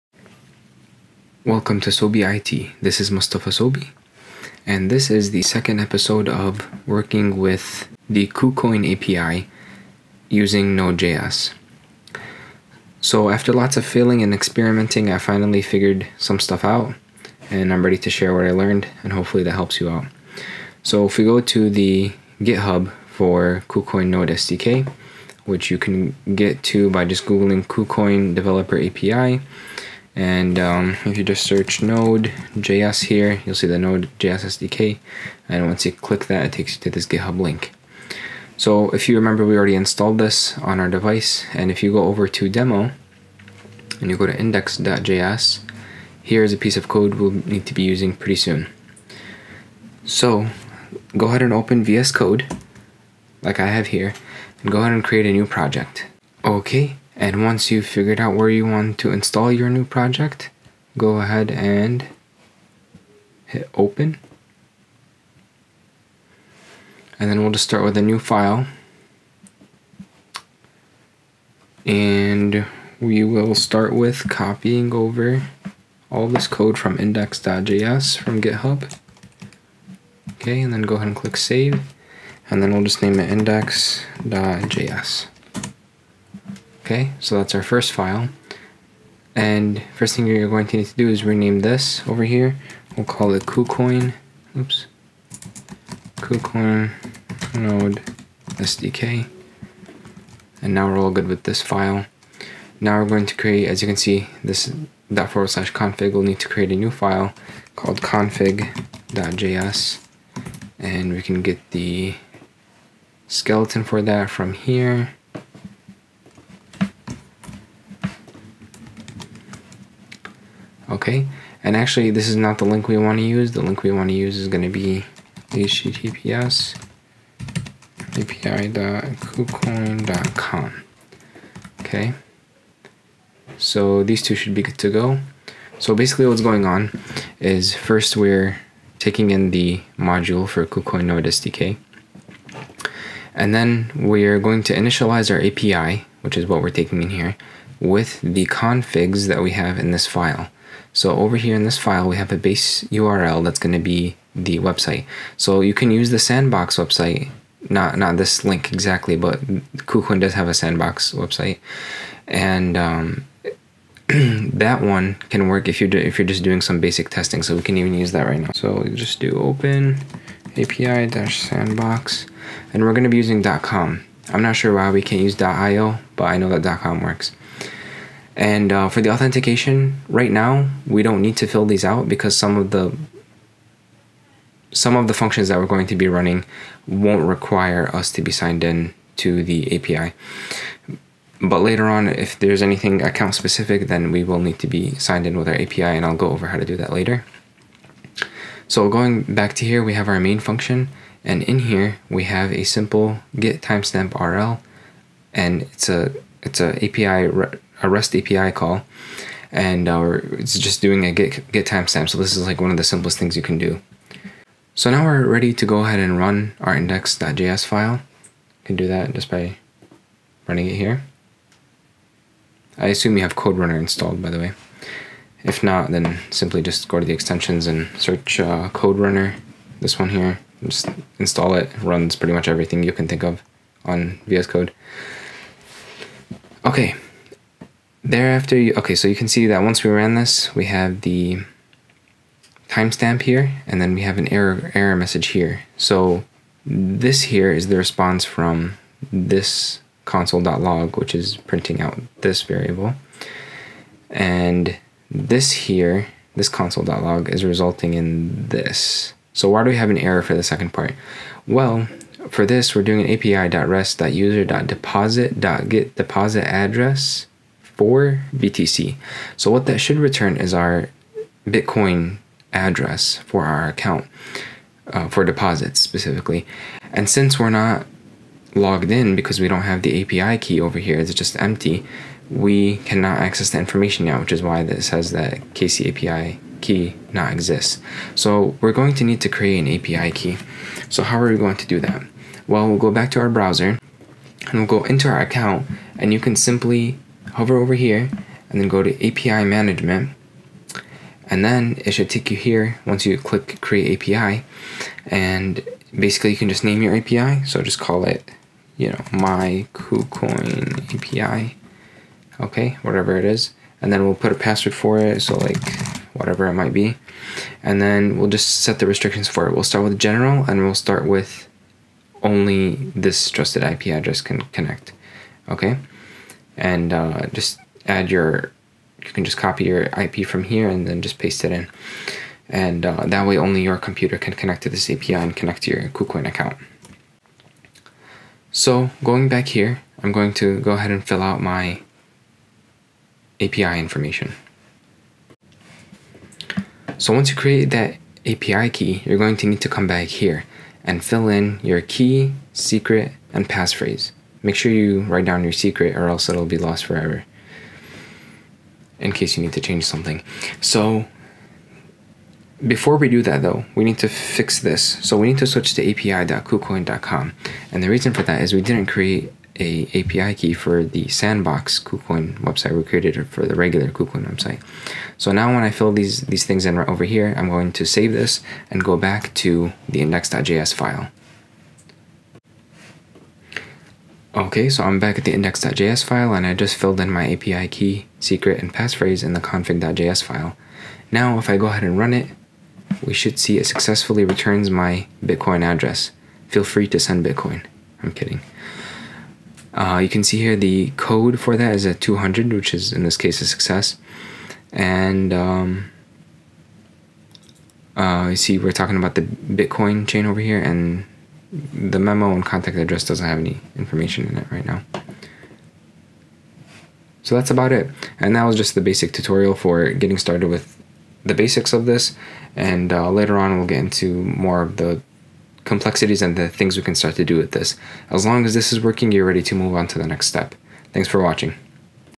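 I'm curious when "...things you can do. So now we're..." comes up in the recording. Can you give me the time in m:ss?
3:33.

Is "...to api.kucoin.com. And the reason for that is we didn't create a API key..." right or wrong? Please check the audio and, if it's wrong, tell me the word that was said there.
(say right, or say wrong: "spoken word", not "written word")
right.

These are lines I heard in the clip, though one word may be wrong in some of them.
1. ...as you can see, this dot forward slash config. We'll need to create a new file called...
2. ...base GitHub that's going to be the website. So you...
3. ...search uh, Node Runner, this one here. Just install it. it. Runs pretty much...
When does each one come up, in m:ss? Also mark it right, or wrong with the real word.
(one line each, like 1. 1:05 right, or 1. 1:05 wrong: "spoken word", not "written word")
1. 1:43 right
2. 2:32 wrong: "URL", not "GitHub"
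3. 3:47 wrong: "Code", not "Node".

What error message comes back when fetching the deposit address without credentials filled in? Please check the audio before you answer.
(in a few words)
KC API key not exists.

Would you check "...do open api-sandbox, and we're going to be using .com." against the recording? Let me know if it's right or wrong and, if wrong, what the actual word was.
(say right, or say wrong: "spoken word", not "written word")
right.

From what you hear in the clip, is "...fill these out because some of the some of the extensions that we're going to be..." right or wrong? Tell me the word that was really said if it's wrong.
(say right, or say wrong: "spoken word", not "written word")
wrong: "functions", not "extensions".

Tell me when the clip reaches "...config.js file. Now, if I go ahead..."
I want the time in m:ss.
6:29.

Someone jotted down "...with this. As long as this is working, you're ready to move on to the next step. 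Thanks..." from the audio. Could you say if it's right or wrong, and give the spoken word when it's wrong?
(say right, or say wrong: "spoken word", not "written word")
right.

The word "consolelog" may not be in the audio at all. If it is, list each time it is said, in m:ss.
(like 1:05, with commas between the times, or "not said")
4:10, 4:16.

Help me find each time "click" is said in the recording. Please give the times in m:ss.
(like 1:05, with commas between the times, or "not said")
0:35, 1:21, 5:03.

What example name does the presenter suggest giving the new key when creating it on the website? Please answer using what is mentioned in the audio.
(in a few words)
my KuCoin API.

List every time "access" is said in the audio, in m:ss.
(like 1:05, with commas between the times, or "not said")
4:43.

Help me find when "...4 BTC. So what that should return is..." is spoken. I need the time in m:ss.
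4:27.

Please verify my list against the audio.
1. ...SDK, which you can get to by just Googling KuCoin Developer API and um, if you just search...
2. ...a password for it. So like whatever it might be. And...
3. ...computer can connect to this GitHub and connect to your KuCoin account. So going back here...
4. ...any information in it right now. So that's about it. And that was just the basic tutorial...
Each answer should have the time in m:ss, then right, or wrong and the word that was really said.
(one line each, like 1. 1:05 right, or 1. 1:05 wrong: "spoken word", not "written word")
1. 0:24 right
2. 5:14 right
3. 5:33 wrong: "API", not "GitHub"
4. 6:53 right.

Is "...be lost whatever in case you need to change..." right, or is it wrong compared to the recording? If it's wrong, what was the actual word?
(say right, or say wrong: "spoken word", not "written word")
wrong: "forever", not "whatever".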